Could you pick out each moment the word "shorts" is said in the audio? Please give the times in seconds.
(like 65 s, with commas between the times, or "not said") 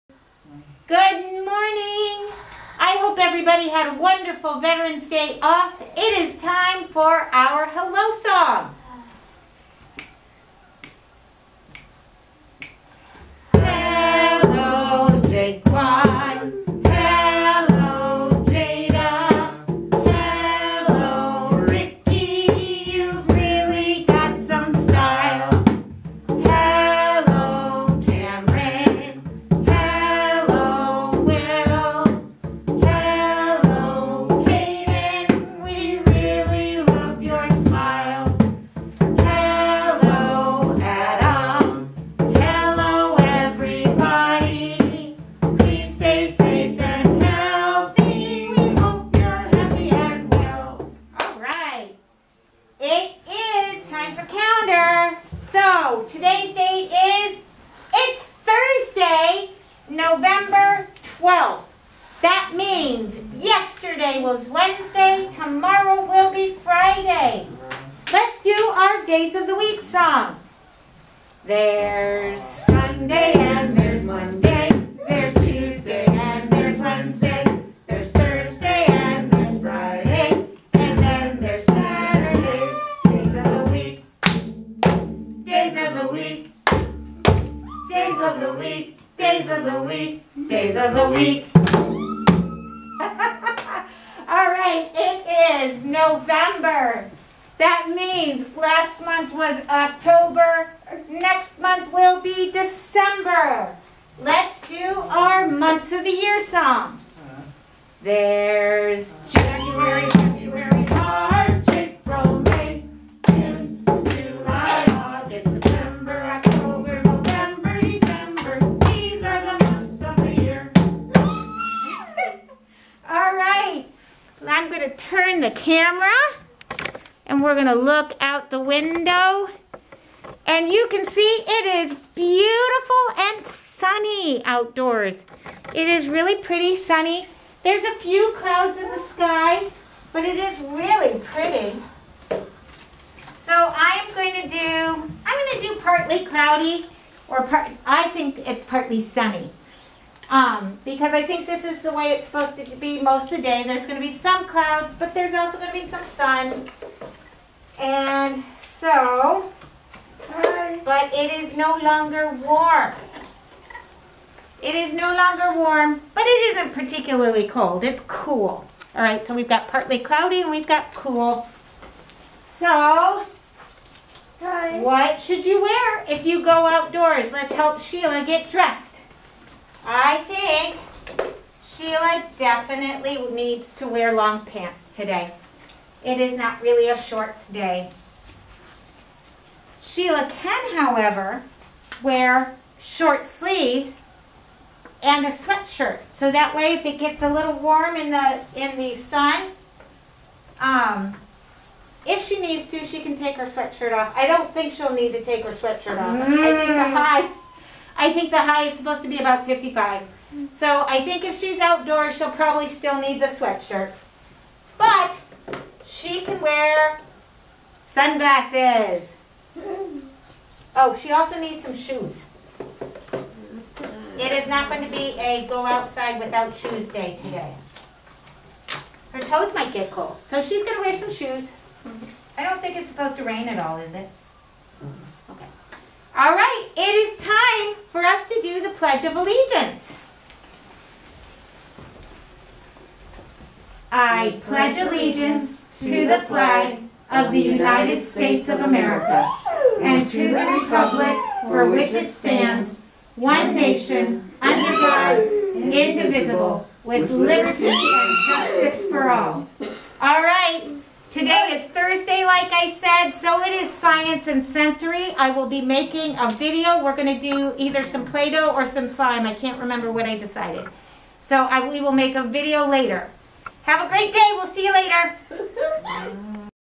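187 s, 192 s.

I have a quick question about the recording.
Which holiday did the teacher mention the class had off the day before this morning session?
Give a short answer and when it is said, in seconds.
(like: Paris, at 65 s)
Veterans Day, at 4 s.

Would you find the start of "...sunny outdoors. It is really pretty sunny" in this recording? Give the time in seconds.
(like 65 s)
133 s.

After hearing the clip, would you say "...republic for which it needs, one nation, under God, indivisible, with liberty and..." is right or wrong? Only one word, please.
wrong.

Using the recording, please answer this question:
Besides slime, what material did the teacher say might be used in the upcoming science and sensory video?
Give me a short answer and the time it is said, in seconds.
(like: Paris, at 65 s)
Play-Doh, at 268 s.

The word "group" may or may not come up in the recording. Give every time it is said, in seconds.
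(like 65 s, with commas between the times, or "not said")
not said.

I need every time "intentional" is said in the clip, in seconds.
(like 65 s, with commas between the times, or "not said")
not said.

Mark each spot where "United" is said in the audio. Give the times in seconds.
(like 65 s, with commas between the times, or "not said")
247 s.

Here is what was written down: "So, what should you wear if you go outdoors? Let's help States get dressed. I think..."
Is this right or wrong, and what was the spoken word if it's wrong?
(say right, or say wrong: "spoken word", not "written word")
wrong: "Sheila", not "States".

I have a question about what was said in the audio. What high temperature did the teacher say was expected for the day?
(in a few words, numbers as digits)
55.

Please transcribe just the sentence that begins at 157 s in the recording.
And so, but it is no longer warm.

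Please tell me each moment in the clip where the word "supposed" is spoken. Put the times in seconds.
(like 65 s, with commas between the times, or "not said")
152 s, 208 s, 232 s.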